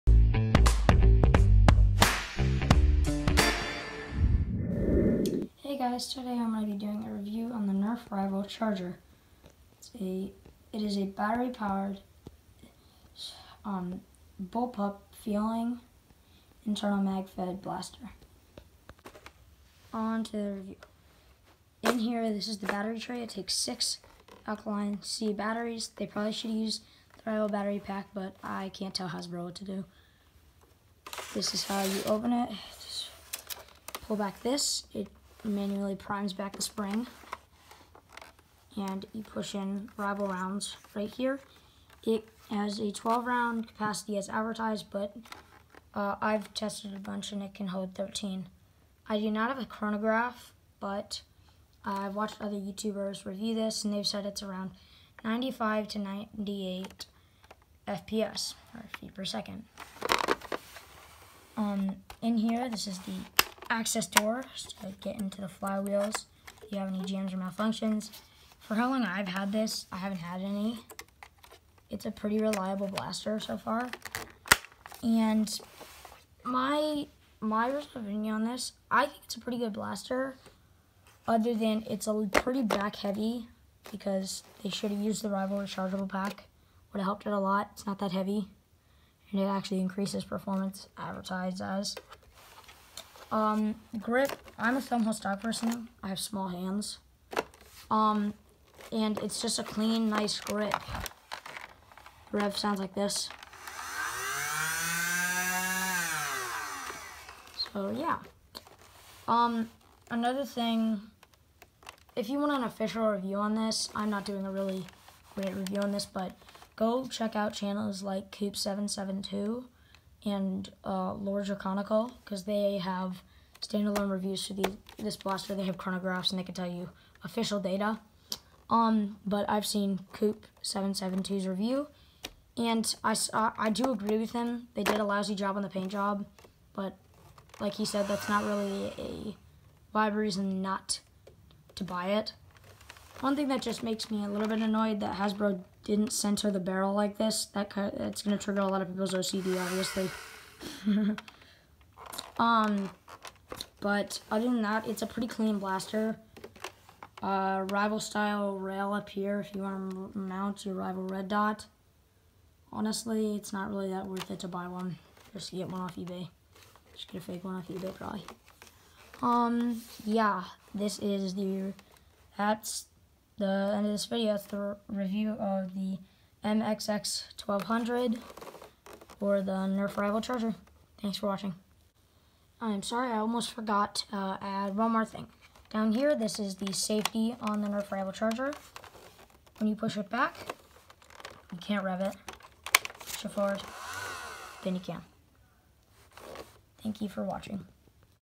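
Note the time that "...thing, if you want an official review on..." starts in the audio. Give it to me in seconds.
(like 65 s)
110 s.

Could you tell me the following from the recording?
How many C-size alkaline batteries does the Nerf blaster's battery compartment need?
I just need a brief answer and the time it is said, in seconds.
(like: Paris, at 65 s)
6, at 23 s.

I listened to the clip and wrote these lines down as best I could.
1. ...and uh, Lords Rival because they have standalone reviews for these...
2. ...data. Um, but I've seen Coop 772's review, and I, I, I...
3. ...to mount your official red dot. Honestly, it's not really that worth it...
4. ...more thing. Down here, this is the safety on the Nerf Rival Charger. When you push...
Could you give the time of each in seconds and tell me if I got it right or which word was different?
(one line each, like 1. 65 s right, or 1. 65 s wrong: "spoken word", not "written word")
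1. 120 s wrong: "Draconical", not "Rival"
2. 127 s right
3. 159 s wrong: "rival", not "official"
4. 184 s right.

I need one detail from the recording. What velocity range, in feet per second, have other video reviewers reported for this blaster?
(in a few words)
95 to 98.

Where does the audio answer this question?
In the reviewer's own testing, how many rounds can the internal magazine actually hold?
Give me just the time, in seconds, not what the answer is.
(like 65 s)
47 s.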